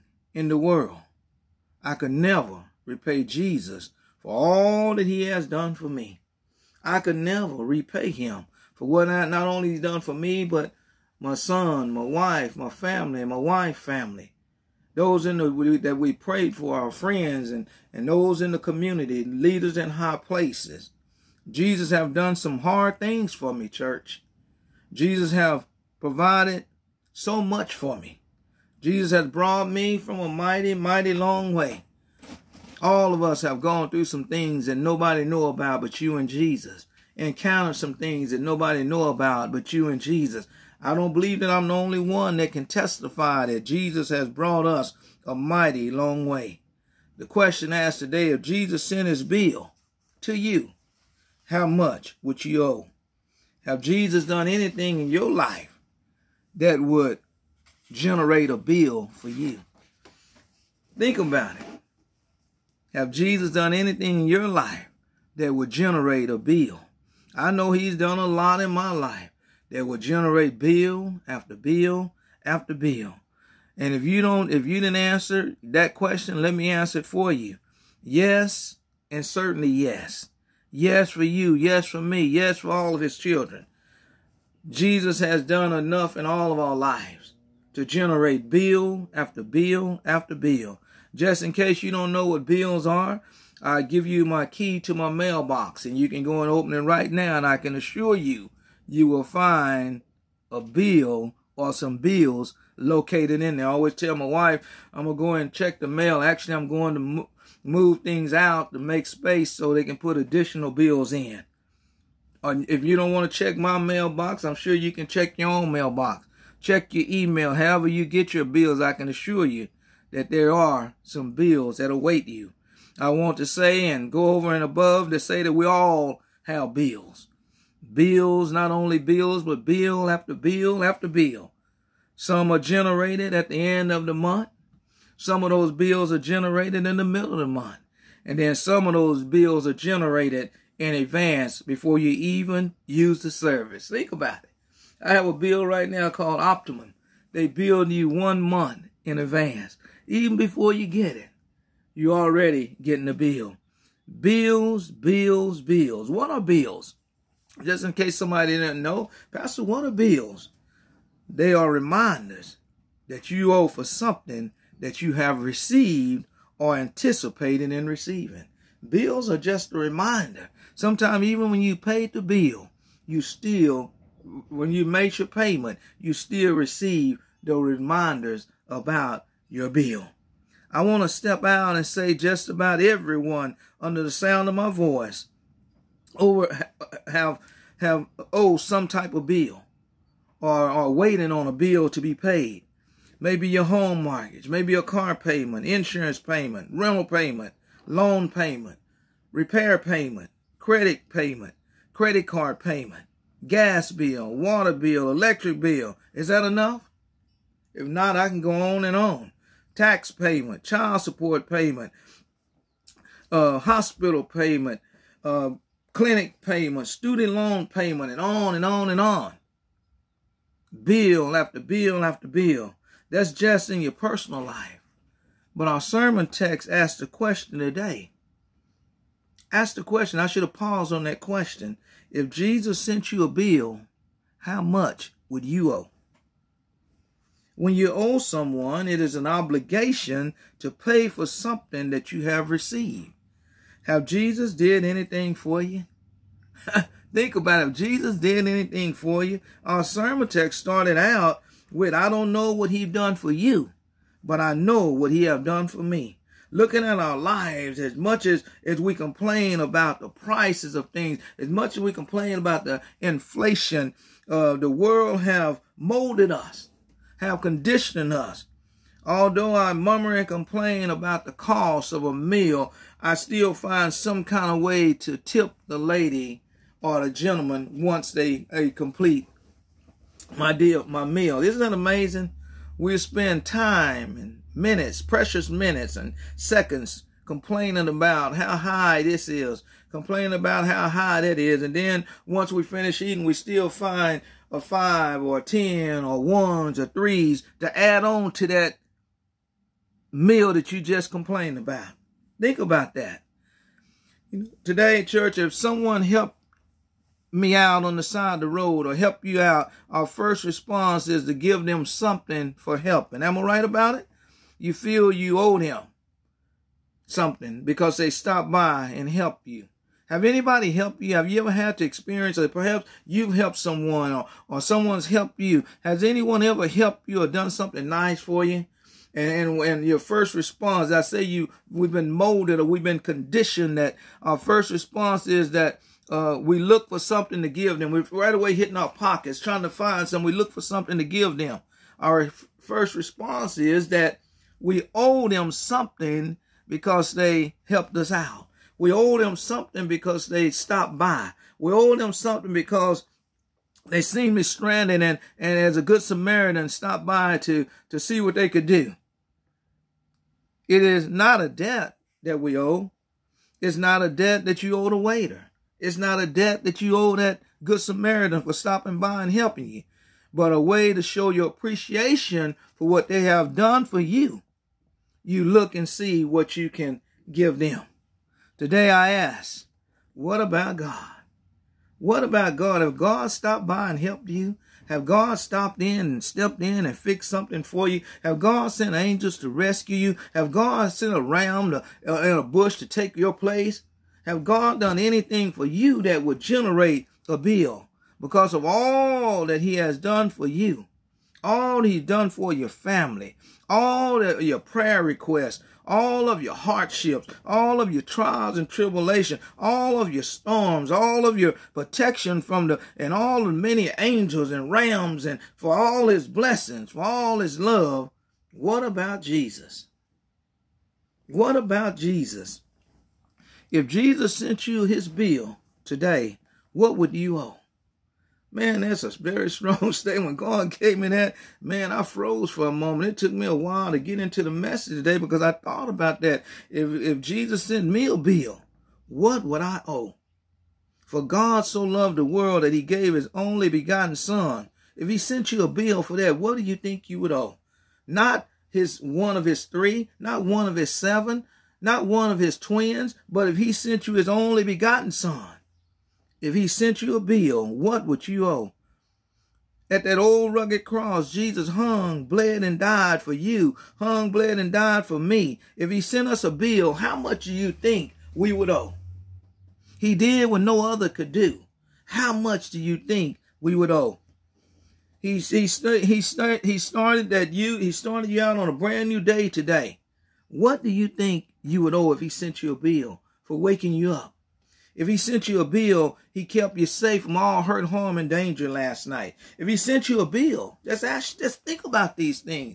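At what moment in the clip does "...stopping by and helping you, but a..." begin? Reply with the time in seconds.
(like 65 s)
368 s.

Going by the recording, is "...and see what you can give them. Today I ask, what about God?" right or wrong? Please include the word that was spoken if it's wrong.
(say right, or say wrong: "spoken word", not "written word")
right.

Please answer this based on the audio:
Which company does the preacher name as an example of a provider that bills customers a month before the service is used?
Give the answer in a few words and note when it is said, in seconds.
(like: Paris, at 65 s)
Optimum, at 146 s.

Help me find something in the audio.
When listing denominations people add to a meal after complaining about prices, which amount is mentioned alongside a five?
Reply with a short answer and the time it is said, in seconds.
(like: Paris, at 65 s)
10, at 295 s.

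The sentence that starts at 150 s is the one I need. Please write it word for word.
Even before you get it, you're already getting the bill.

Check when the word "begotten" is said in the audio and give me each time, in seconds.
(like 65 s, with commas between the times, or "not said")
443 s, 454 s.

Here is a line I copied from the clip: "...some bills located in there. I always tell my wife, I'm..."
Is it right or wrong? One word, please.
right.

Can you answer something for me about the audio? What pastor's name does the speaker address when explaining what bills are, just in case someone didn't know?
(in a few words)
Pastor Warner.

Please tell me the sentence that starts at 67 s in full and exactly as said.
I know he's done a lot in my life that will generate bill after bill after bill.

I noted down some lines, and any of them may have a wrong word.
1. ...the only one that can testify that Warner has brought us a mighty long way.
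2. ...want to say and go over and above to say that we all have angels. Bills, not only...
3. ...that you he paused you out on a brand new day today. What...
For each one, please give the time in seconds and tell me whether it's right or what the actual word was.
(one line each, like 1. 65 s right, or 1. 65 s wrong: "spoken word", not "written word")
1. 41 s wrong: "Jesus", not "Warner"
2. 123 s wrong: "bills", not "angels"
3. 477 s wrong: "started", not "paused".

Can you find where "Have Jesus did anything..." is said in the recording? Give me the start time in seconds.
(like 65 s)
243 s.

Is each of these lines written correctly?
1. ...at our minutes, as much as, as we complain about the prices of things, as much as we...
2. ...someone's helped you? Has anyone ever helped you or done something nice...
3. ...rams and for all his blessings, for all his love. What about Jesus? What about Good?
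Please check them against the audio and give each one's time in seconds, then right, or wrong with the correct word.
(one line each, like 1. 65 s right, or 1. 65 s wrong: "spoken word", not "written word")
1. 256 s wrong: "lives", not "minutes"
2. 324 s right
3. 414 s wrong: "Jesus", not "Good".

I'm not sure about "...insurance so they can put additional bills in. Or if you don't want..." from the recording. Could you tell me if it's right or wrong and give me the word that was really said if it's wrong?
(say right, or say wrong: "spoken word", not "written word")
wrong: "space", not "insurance".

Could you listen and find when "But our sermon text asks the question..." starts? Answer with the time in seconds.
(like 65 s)
225 s.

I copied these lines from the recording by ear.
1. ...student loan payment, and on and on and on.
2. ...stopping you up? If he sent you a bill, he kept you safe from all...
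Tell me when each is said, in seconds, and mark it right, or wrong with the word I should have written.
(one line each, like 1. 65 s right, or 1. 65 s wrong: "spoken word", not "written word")
1. 216 s right
2. 483 s wrong: "waking", not "stopping".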